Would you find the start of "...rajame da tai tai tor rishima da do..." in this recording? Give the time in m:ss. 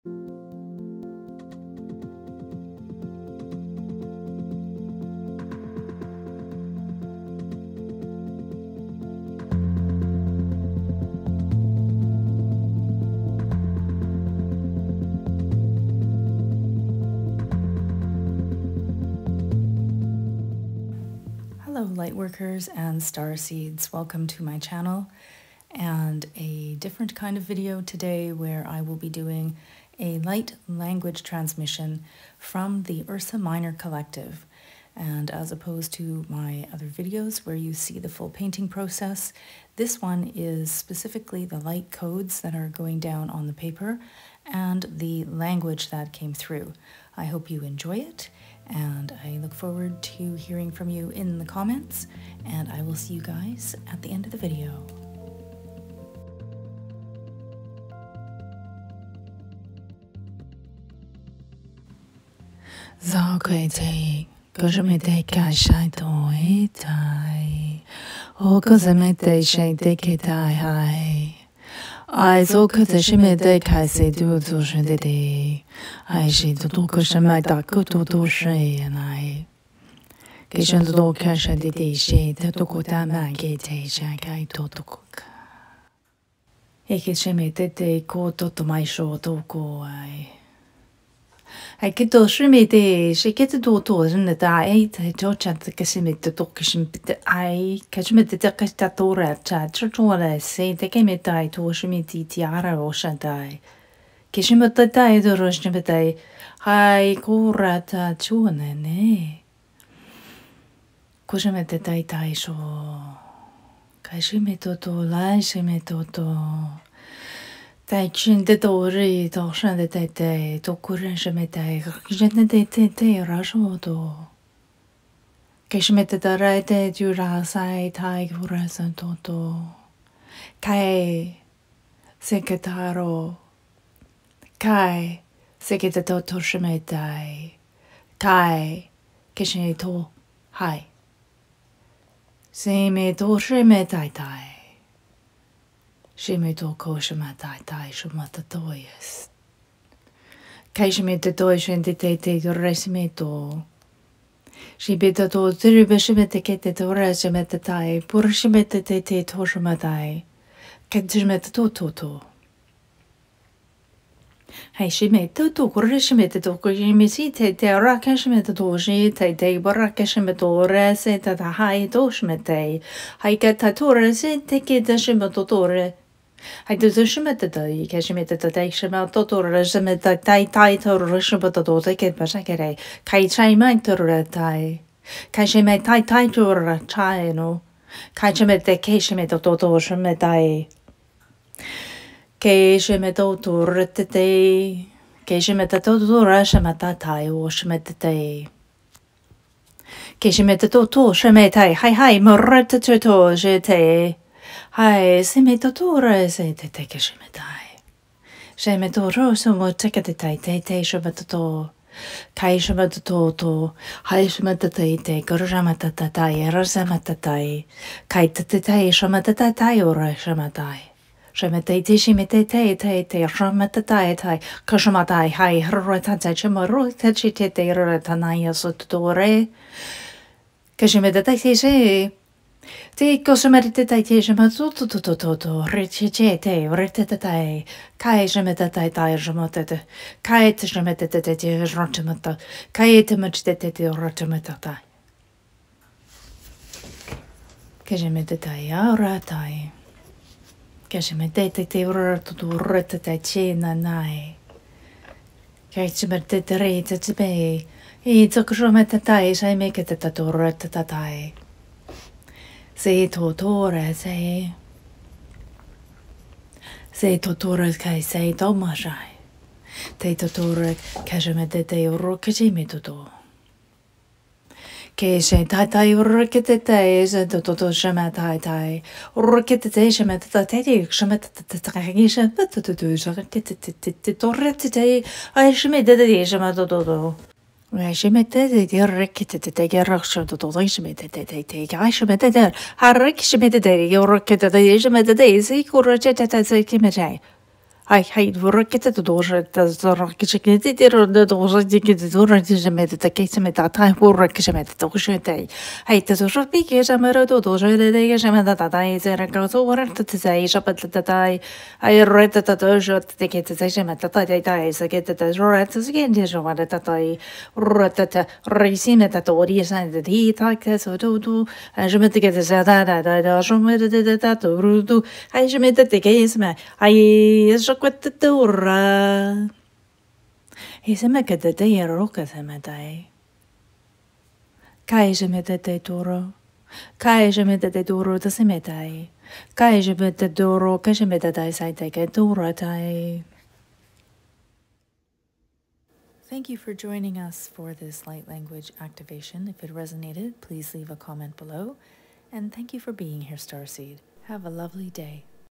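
2:59.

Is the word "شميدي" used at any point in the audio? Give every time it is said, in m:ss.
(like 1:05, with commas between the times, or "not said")
1:32, 1:41.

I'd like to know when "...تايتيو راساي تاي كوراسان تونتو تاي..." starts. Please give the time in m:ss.
2:06.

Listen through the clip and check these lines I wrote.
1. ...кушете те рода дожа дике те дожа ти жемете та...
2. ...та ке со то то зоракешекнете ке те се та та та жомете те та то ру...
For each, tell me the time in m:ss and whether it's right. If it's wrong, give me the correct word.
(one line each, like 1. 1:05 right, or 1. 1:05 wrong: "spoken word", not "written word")
1. 4:59 wrong: "зоракешекнете", not "кушете"
2. 5:20 wrong: "жемете", not "зоракешекнете".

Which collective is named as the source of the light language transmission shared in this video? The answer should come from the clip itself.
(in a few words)
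Ursa Minor Collective.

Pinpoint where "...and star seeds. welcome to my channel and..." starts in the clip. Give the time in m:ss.
0:22.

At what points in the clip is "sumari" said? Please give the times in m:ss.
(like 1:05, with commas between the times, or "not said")
3:53.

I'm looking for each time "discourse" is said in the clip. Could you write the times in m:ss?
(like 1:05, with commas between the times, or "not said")
not said.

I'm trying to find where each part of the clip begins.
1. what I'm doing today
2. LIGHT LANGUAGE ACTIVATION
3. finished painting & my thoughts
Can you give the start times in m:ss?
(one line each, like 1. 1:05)
1. 0:23
2. 1:30
3. 5:45.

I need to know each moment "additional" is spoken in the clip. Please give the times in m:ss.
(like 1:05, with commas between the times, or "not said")
not said.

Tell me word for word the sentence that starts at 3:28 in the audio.
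Shemeto rosumo tekaditai te te shabatato.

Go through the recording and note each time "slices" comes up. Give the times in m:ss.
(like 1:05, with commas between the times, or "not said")
not said.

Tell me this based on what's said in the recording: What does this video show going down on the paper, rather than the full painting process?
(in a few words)
light codes.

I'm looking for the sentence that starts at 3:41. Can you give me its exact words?
Shemetai te shimite te te te shamatatai tai.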